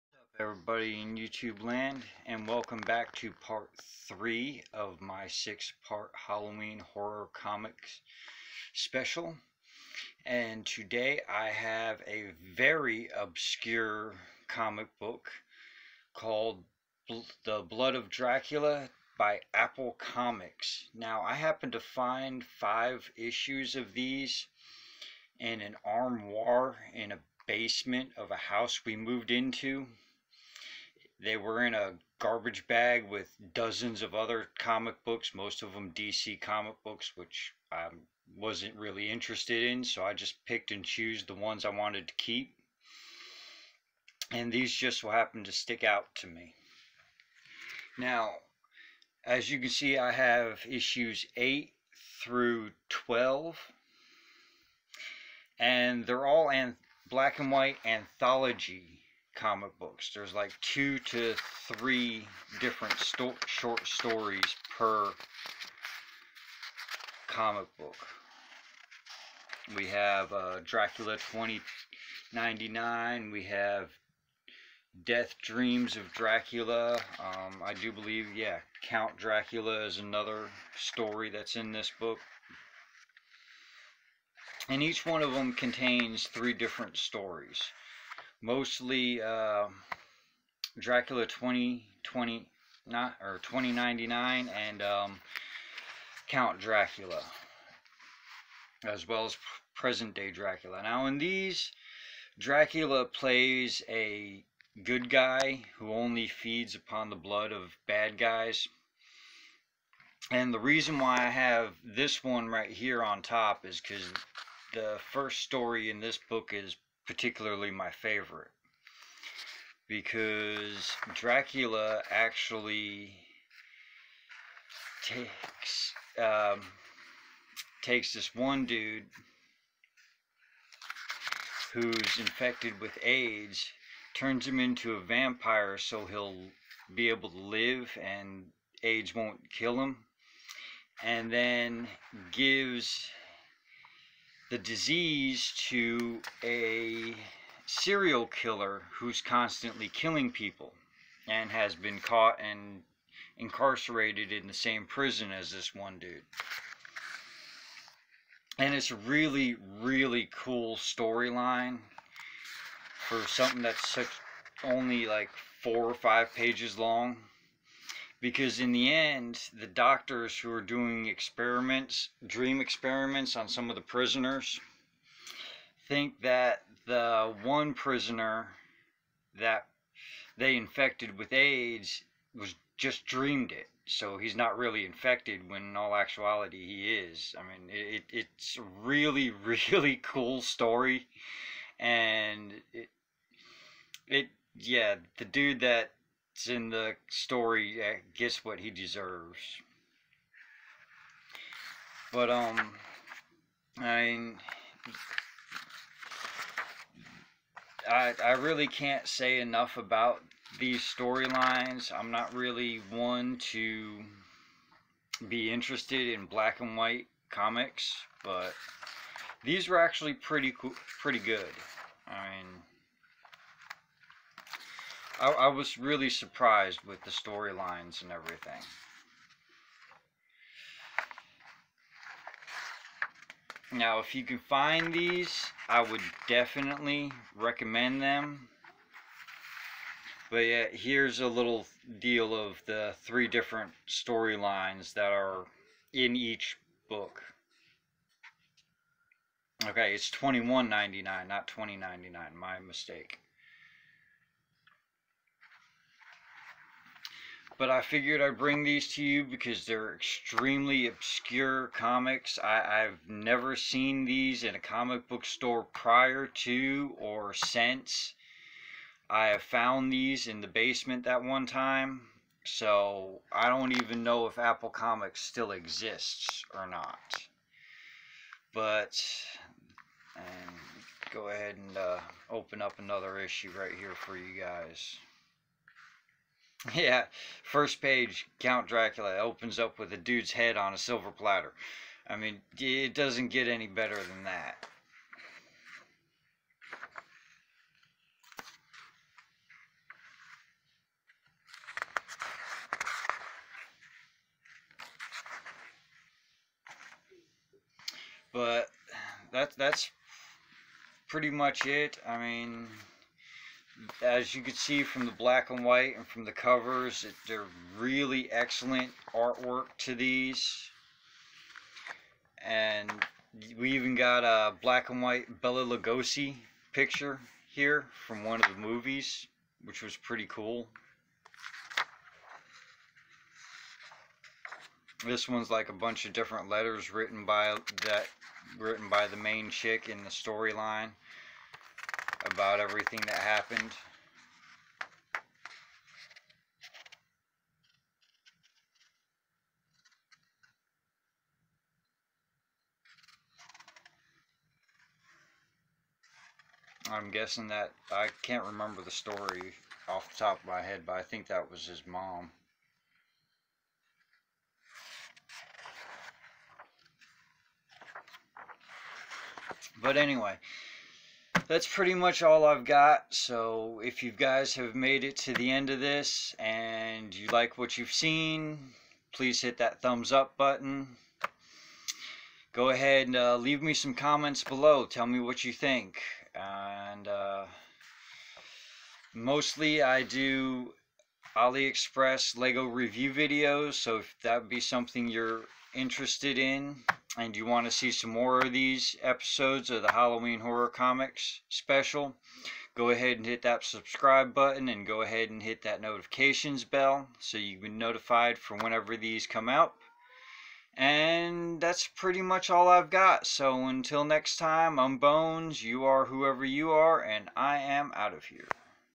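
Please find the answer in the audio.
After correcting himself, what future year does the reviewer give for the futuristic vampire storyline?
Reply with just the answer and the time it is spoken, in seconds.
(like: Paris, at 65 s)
2199, at 250 s.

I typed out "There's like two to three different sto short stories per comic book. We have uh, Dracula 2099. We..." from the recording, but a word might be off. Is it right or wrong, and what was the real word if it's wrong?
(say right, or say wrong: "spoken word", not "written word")
right.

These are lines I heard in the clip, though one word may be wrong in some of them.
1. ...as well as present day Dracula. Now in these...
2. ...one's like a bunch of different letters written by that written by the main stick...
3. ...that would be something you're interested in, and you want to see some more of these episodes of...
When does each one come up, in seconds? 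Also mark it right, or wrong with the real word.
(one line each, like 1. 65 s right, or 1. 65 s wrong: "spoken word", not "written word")
1. 98 s right
2. 335 s wrong: "chick", not "stick"
3. 394 s right.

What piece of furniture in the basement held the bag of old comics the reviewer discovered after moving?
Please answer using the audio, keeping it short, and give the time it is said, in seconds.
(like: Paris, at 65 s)
An armoire, at 25 s.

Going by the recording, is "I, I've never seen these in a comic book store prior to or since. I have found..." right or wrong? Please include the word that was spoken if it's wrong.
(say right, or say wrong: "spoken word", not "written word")
right.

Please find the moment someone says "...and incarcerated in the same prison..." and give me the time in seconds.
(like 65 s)
152 s.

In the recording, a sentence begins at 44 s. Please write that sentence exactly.
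And these just so happened to stick out to me.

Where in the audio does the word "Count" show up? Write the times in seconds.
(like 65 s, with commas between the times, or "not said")
78 s, 96 s, 288 s.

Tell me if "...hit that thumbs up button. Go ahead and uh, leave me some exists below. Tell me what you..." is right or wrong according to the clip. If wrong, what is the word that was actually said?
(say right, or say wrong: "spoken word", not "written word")
wrong: "comments", not "exists".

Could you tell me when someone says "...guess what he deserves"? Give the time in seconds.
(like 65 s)
198 s.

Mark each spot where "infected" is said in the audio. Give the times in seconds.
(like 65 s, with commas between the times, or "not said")
132 s, 180 s, 184 s.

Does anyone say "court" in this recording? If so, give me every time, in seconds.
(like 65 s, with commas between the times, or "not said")
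not said.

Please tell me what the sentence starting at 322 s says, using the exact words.
And we even got a black and white Bela Lugosi picture here from one of the movies, which was pretty cool.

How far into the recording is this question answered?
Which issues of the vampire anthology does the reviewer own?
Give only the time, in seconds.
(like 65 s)
51 s.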